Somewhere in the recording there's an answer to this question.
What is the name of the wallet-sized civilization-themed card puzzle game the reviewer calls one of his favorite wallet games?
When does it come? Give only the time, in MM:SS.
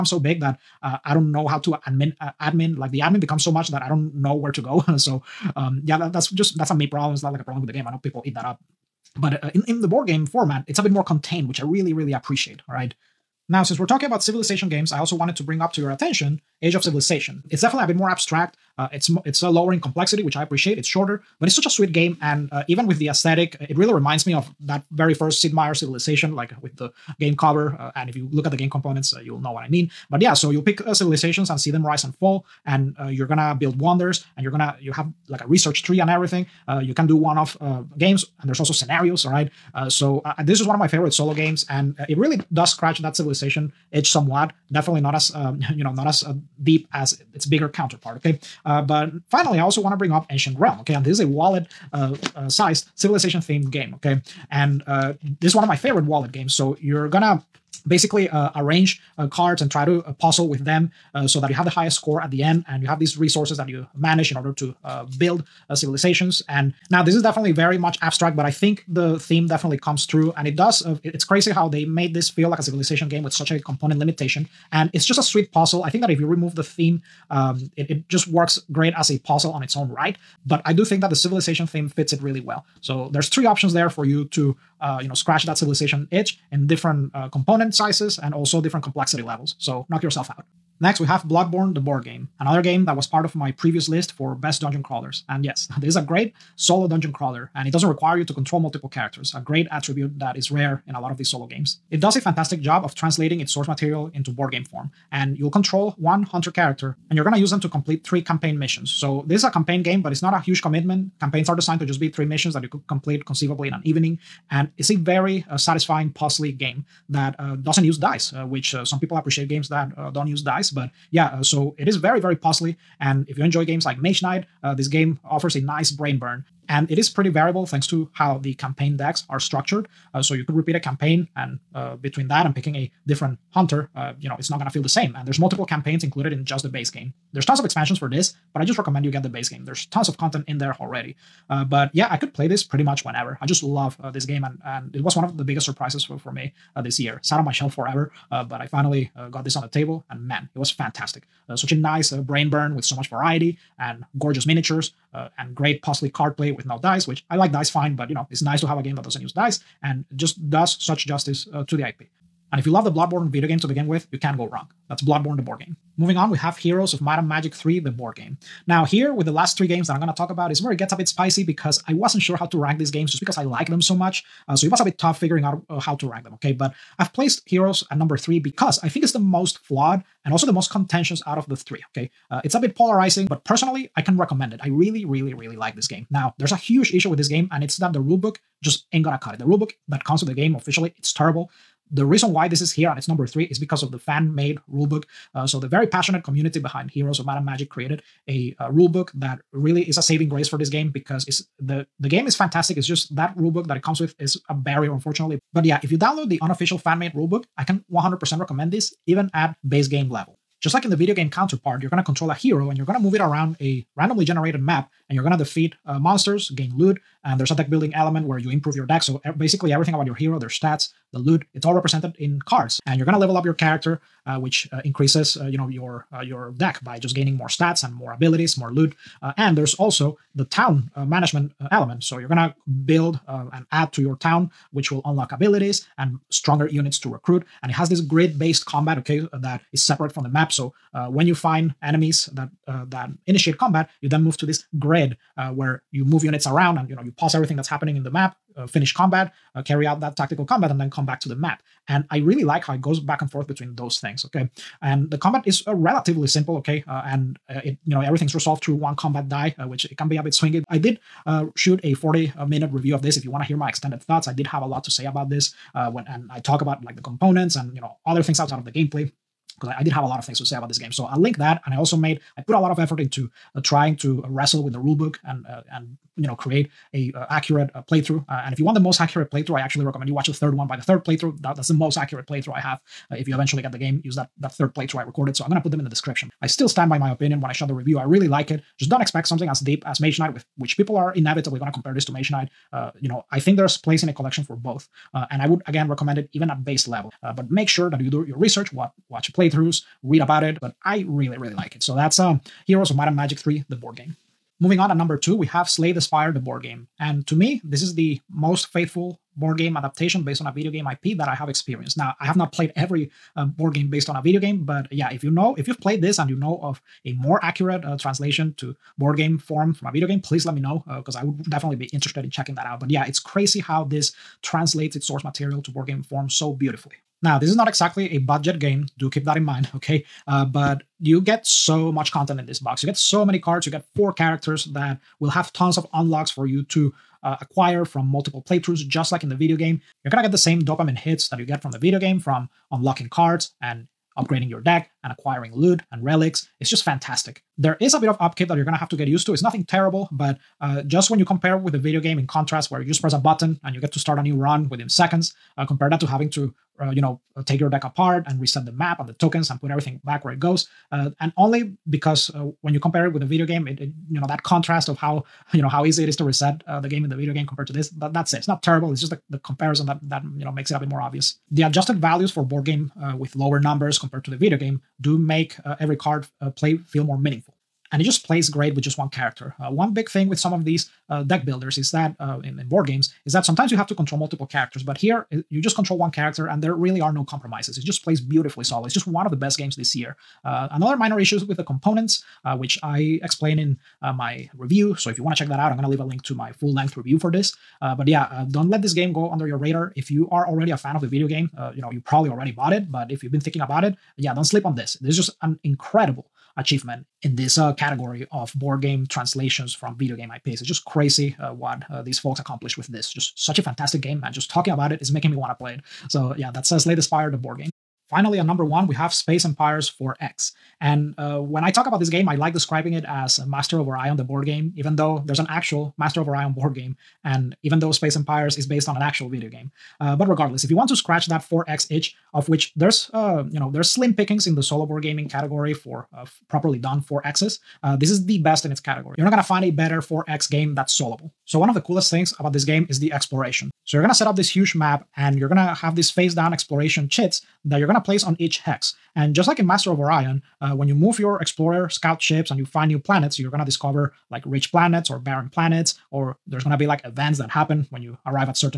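00:50.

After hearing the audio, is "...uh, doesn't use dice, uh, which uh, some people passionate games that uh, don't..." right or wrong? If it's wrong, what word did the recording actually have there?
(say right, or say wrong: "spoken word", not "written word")
wrong: "appreciate", not "passionate".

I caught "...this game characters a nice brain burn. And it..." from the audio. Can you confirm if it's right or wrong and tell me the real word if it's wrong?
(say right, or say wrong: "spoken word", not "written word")
wrong: "offers", not "characters".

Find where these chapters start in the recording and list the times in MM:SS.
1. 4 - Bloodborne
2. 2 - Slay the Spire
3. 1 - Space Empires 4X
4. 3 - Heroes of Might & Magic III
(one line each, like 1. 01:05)
1. 01:30
2. 05:04
3. 06:57
4. 02:52.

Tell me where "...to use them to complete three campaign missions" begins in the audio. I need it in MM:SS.
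01:47.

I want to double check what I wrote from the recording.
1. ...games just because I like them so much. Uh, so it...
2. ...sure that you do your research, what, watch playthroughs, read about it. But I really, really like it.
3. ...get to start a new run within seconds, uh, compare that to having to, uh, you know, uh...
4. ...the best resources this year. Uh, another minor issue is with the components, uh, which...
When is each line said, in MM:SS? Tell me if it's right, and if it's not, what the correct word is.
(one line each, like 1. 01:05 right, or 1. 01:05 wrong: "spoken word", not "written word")
1. 02:52 right
2. 04:57 right
3. 05:53 right
4. 06:29 wrong: "games", not "resources".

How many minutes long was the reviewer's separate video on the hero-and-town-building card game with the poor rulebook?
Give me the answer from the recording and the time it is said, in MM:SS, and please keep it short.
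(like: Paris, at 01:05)
40, at 04:21.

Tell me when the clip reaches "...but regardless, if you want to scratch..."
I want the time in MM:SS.
07:10.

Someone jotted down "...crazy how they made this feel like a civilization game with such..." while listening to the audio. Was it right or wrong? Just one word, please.
right.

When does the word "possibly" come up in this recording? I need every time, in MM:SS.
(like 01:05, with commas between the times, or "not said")
02:35.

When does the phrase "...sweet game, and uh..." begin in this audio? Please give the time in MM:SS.
00:21.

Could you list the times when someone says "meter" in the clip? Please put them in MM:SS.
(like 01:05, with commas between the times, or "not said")
not said.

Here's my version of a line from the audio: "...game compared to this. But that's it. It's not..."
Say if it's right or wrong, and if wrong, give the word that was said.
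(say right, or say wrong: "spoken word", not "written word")
right.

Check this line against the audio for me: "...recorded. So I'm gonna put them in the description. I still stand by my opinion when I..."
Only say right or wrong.
right.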